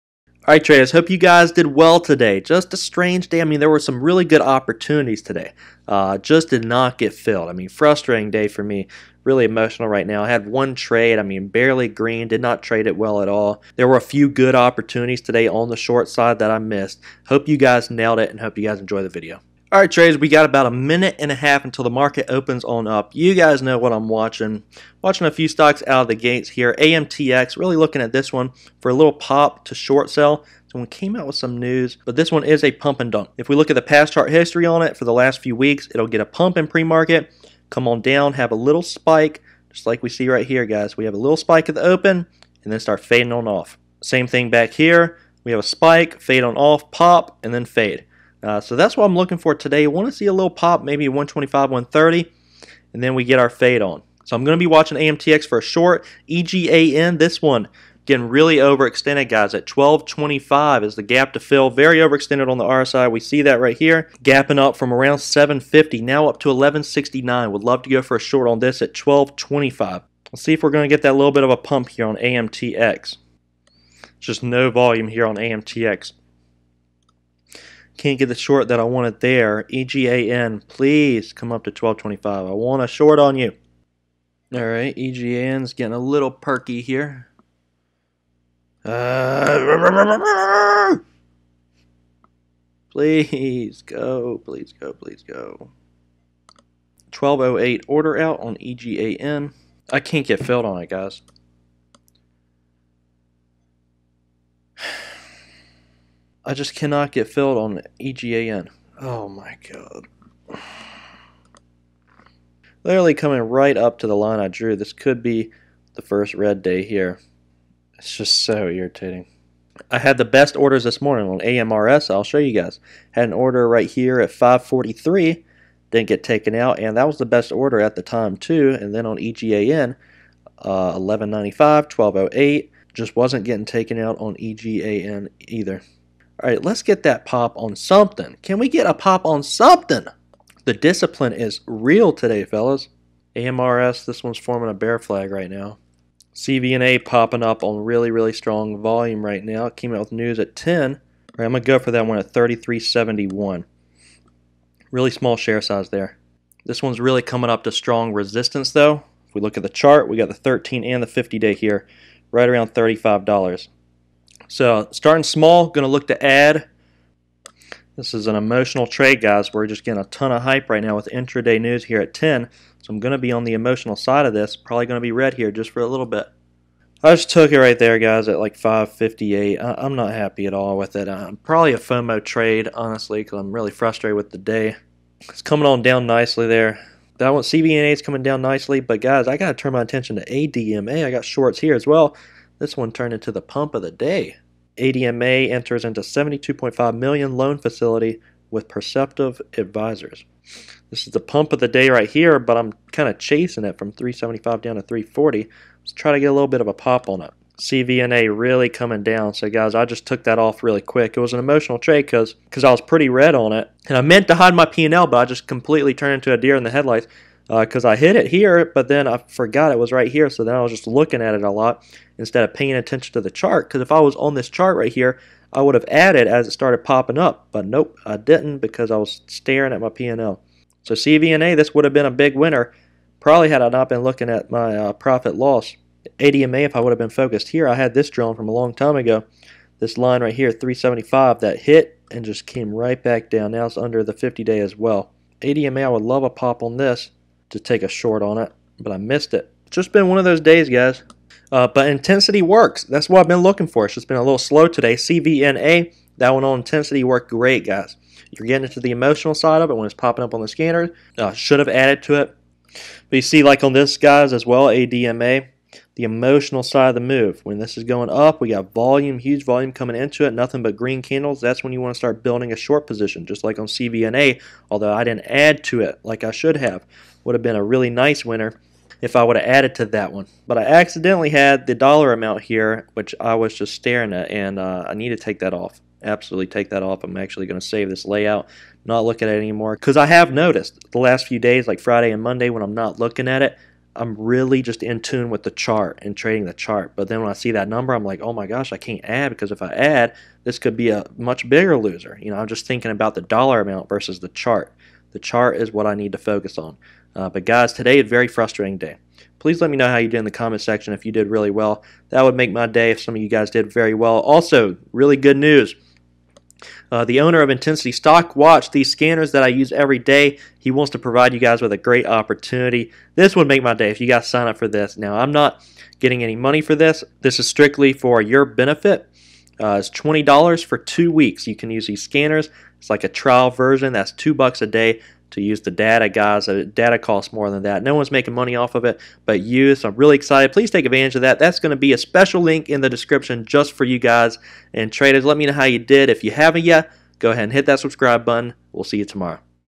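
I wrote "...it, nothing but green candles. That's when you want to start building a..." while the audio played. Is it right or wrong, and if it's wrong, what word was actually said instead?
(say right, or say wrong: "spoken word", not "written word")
right.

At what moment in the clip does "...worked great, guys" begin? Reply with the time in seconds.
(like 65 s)
257 s.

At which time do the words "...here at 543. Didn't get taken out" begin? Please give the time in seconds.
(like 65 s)
123 s.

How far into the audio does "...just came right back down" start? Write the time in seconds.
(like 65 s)
242 s.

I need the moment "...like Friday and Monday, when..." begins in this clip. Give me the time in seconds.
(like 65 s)
291 s.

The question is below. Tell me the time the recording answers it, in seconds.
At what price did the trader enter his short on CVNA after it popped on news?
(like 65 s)
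152 s.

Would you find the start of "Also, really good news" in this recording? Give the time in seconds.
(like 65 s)
314 s.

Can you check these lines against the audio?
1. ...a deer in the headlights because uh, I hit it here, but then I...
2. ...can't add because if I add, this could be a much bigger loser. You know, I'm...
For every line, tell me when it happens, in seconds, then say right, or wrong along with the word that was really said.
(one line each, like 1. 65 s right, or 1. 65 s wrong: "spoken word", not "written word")
1. 216 s right
2. 298 s right.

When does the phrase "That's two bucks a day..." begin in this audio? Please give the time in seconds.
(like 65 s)
333 s.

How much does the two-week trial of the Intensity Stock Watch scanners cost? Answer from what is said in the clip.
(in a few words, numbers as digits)
$20.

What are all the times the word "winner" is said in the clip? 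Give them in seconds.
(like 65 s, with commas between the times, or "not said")
232 s, 278 s.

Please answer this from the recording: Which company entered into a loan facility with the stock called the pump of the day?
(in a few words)
Perceptive Advisors.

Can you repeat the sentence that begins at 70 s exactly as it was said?
Let's see if we're going to get that little bit of a pump here on AMTX.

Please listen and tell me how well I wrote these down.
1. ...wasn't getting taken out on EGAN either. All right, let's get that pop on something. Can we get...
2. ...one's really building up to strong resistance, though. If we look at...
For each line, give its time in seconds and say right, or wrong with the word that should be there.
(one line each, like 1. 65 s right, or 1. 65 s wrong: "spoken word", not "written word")
1. 133 s right
2. 156 s wrong: "coming", not "building".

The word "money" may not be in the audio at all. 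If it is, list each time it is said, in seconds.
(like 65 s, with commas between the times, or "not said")
326 s, 338 s.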